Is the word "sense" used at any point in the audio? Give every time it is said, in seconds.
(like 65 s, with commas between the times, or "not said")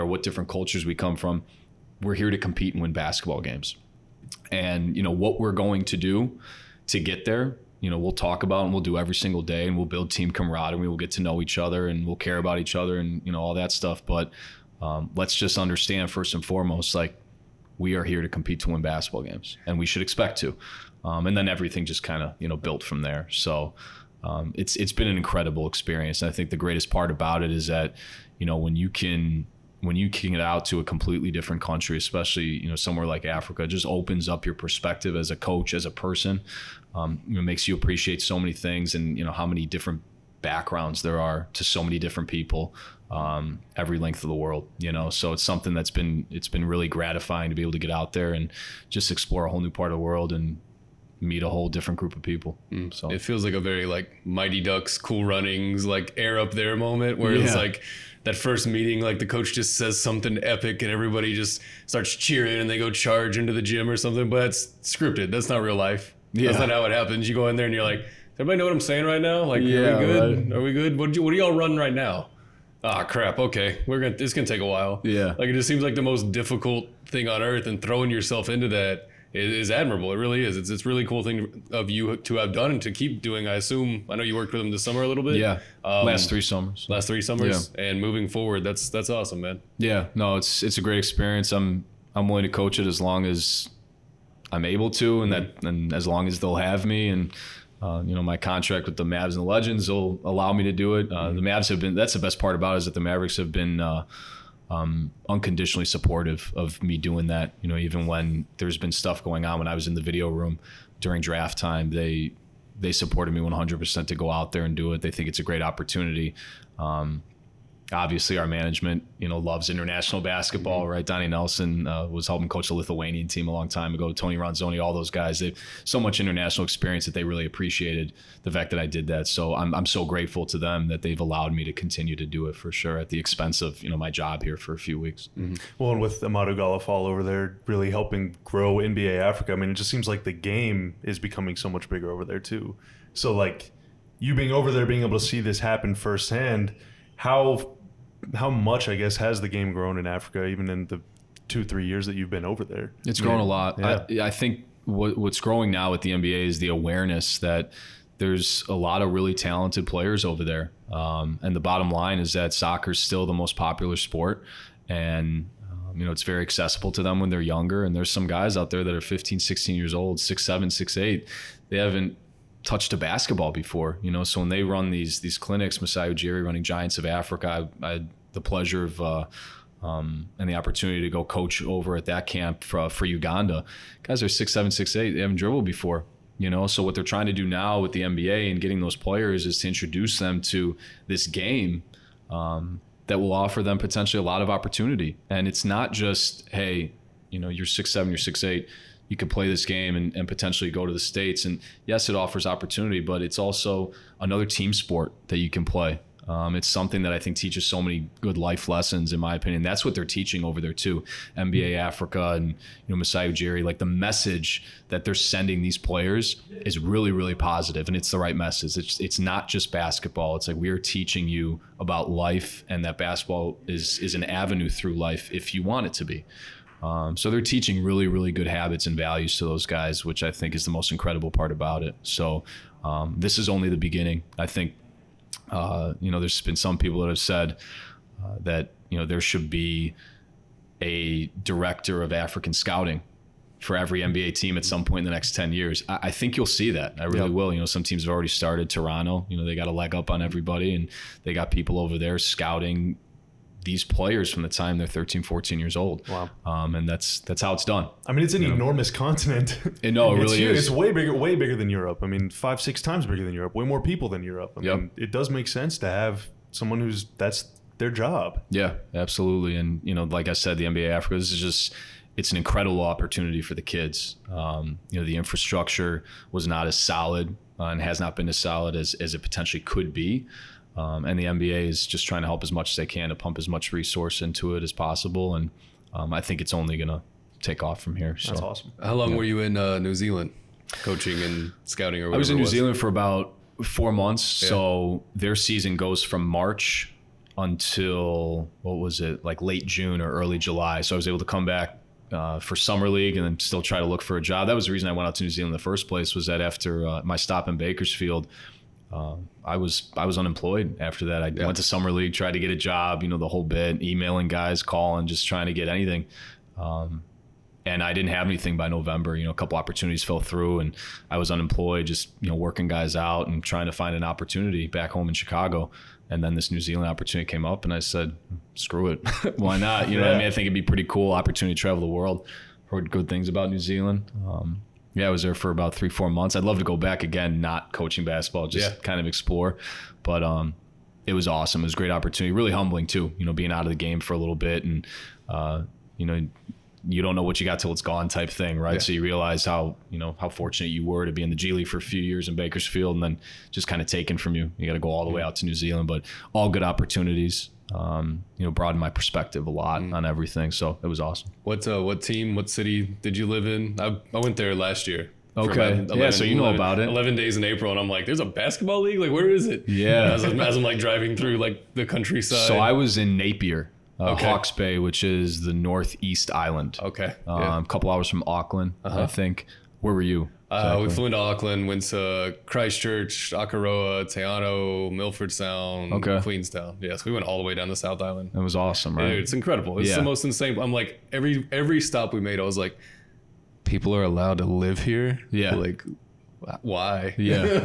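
265 s.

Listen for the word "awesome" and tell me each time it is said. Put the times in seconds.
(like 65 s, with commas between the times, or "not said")
89 s, 288 s, 341 s, 360 s, 388 s.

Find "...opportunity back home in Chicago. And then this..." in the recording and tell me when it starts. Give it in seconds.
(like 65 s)
324 s.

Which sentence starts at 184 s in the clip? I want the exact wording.
Guys are six seven, six eight.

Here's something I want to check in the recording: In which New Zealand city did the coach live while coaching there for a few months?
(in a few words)
Napier.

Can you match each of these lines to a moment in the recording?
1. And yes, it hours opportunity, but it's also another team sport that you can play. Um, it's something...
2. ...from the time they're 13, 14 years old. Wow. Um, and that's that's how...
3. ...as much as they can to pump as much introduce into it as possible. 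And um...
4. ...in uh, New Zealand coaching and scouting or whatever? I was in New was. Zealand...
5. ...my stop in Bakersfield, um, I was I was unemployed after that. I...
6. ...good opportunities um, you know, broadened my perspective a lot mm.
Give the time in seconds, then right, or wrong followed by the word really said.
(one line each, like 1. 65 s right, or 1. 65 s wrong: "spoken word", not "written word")
1. 201 s wrong: "offers", not "hours"
2. 254 s right
3. 282 s wrong: "resource", not "introduce"
4. 289 s right
5. 307 s right
6. 356 s right.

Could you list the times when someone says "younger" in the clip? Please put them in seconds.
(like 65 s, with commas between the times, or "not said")
167 s.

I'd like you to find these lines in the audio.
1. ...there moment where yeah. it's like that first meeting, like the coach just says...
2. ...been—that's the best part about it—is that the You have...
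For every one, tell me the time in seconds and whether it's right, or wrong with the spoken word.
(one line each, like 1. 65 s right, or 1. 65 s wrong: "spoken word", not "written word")
1. 56 s right
2. 101 s wrong: "Mavericks", not "You".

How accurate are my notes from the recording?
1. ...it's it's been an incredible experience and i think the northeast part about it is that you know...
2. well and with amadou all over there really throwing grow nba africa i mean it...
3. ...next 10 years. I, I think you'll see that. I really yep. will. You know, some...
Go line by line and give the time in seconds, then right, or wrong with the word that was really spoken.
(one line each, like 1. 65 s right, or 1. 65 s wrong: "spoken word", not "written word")
1. 24 s wrong: "greatest", not "northeast"
2. 135 s wrong: "helping", not "throwing"
3. 245 s right.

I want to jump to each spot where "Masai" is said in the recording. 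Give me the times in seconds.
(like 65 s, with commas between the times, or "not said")
175 s, 212 s.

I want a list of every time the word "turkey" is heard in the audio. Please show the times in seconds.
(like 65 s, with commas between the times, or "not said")
not said.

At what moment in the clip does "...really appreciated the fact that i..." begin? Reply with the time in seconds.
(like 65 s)
127 s.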